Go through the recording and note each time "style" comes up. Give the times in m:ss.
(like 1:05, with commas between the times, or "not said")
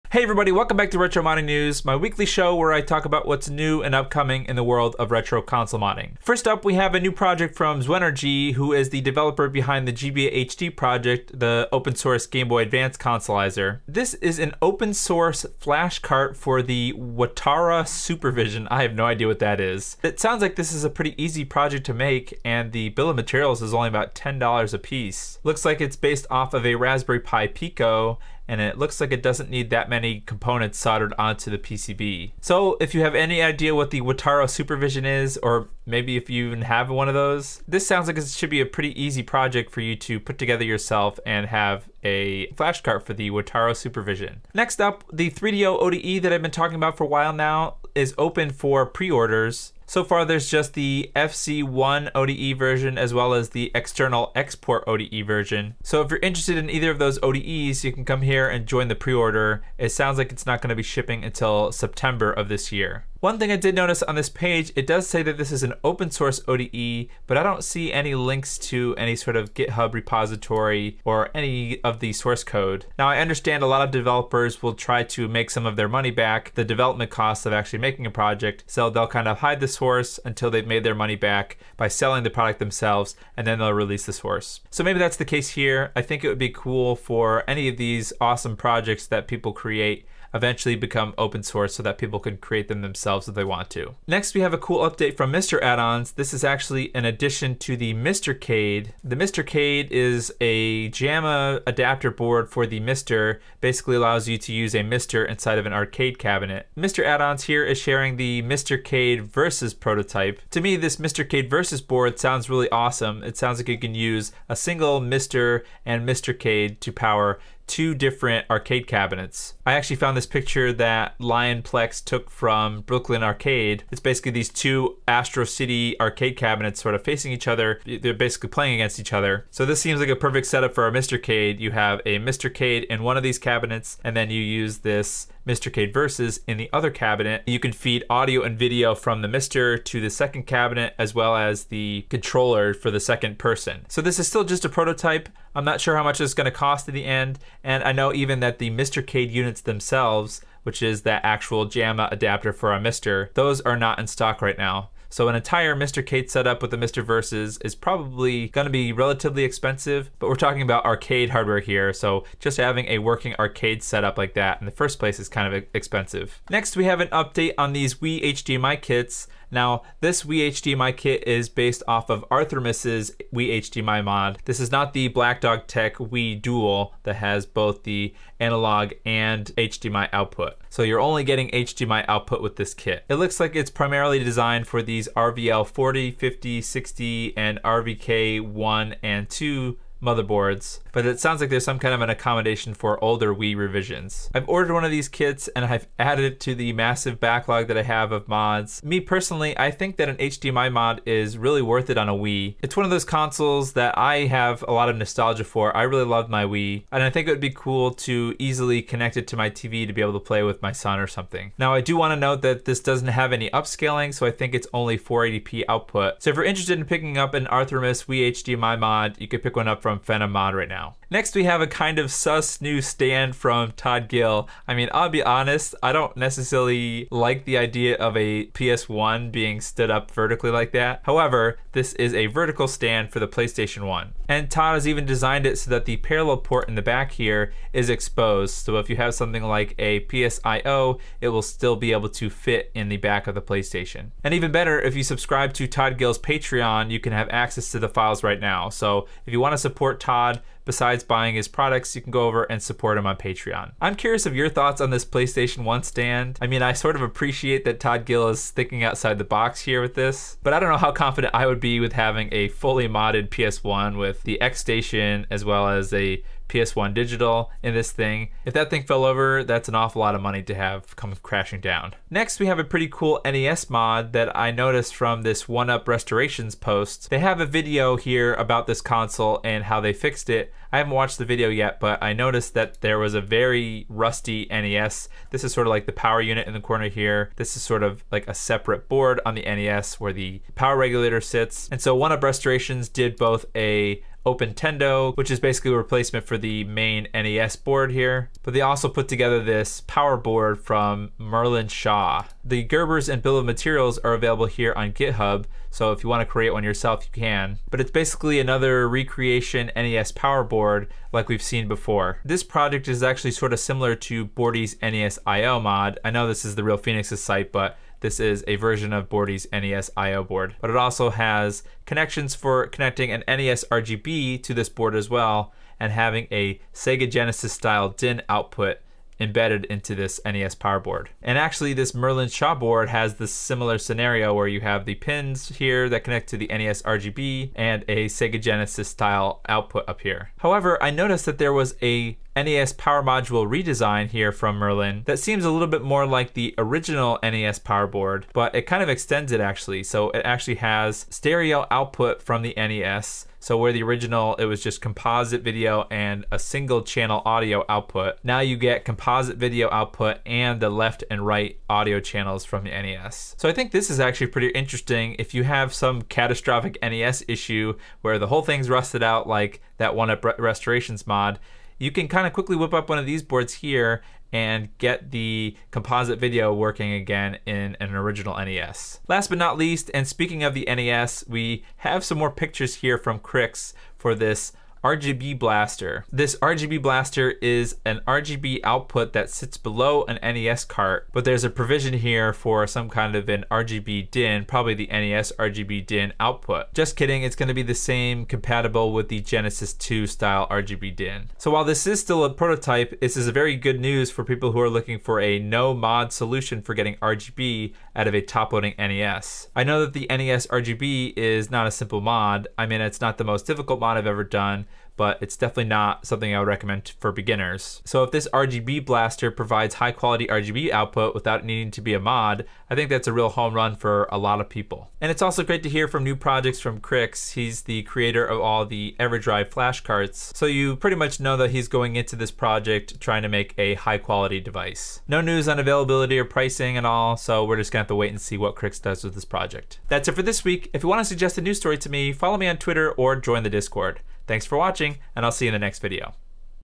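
5:27, 5:38, 6:40.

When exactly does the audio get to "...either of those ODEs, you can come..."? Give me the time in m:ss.
0:56.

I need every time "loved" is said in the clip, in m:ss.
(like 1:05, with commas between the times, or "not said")
3:26.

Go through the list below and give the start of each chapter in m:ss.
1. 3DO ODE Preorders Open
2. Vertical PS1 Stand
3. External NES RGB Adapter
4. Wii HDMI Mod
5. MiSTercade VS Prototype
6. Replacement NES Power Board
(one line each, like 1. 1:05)
1. 0:44
2. 3:40
3. 6:19
4. 2:46
5. 1:33
6. 4:32.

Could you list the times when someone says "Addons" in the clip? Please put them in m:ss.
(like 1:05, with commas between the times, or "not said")
1:35, 1:47.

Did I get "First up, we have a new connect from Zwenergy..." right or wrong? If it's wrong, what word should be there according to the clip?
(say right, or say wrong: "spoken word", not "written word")
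wrong: "project", not "connect".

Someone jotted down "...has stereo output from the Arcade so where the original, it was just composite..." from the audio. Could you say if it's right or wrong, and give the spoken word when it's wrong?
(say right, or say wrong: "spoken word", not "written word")
wrong: "NES", not "Arcade".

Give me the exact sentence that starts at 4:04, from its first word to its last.
And even better, if you subscribe to Todd Gill's Patreon, you can have access to the files right now.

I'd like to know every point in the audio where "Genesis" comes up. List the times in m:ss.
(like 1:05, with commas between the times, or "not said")
5:27, 5:38, 6:39.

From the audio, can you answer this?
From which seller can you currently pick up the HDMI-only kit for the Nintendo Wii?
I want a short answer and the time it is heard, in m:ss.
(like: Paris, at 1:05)
Phenom Mod, at 3:40.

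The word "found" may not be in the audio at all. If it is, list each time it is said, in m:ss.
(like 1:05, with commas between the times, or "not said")
1:59.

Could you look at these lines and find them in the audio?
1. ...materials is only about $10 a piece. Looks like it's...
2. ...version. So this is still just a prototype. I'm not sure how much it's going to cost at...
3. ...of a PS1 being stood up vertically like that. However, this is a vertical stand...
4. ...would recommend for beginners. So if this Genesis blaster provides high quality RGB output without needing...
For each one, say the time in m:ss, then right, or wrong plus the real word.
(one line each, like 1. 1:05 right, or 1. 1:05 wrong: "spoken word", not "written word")
1. 0:23 right
2. 2:23 wrong: "person", not "version"
3. 3:47 right
4. 6:56 wrong: "RGB", not "Genesis".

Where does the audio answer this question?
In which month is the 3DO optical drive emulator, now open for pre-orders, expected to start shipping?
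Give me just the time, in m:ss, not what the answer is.
1:01.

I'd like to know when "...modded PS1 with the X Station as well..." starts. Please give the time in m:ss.
4:22.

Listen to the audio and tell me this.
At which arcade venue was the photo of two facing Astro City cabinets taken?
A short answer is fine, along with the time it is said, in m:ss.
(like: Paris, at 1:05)
Brooklyn Arcade, at 2:02.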